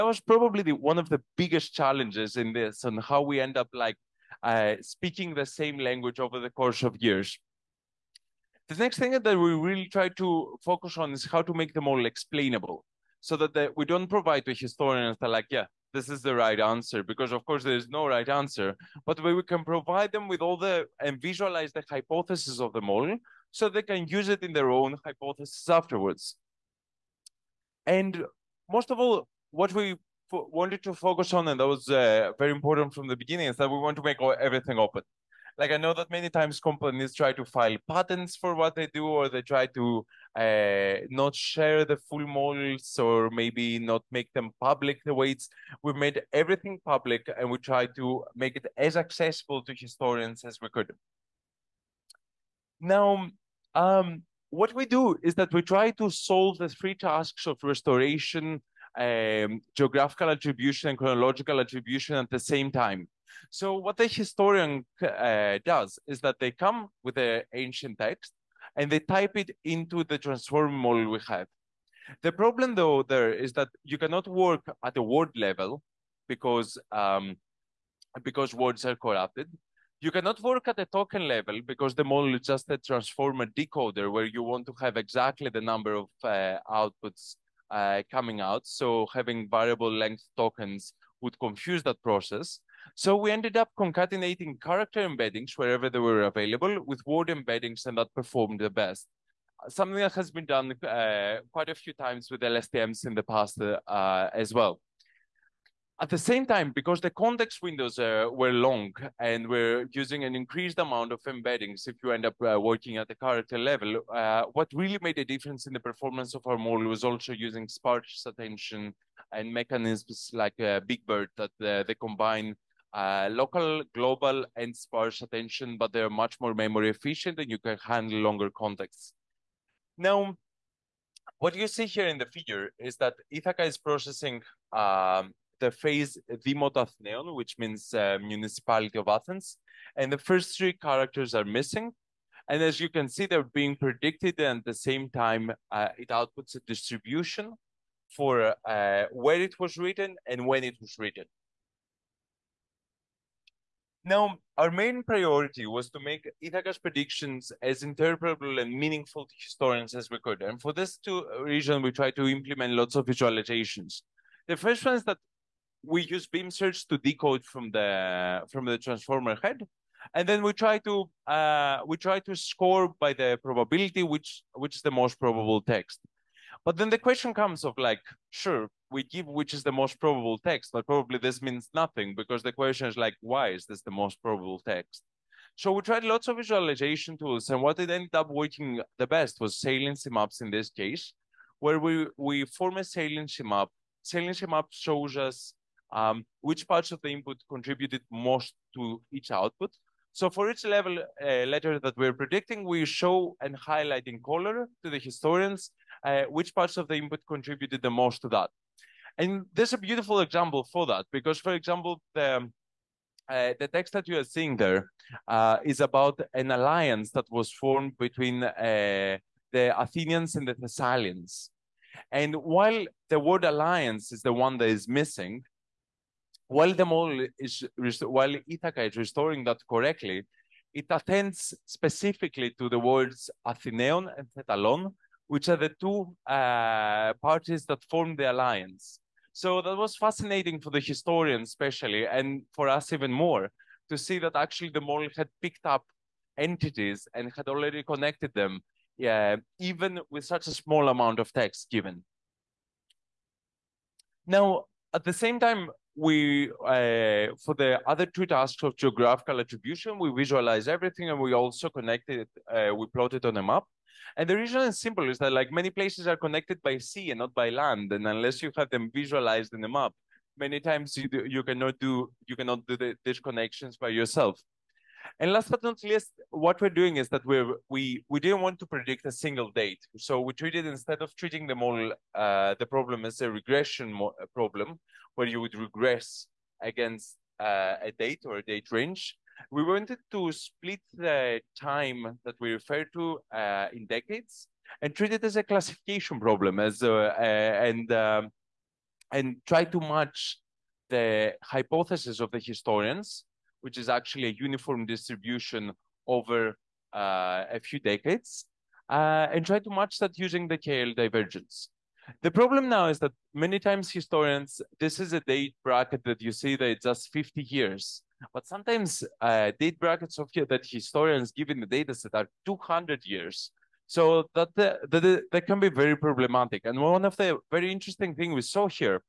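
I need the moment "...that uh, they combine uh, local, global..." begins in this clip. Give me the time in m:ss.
2:01.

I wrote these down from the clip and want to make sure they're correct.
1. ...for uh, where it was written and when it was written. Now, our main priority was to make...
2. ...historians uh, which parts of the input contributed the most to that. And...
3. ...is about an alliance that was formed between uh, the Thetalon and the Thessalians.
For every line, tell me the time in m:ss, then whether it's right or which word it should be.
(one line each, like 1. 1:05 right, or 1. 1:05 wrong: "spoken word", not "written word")
1. 2:28 right
2. 3:24 right
3. 3:35 wrong: "Athenians", not "Thetalon".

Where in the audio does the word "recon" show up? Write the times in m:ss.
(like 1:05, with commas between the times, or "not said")
not said.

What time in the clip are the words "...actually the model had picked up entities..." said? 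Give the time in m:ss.
4:04.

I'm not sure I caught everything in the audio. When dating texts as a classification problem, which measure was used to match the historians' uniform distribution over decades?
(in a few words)
KL divergence.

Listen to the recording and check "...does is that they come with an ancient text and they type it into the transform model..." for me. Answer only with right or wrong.
right.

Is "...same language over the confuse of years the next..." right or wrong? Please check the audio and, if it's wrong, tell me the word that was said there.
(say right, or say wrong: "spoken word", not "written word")
wrong: "course", not "confuse".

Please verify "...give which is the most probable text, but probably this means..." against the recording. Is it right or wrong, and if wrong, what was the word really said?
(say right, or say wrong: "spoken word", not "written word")
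right.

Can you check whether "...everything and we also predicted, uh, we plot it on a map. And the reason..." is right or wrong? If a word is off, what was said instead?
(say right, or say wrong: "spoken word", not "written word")
wrong: "connected", not "predicted".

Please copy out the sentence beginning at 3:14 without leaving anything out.
Saliency map shows us um, which parts of the input contributed most to each output.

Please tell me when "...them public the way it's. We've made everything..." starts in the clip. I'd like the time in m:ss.
0:44.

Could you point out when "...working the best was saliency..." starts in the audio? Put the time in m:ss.
3:08.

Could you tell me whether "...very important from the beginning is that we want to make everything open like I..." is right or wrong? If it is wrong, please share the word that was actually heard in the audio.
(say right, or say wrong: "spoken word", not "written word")
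right.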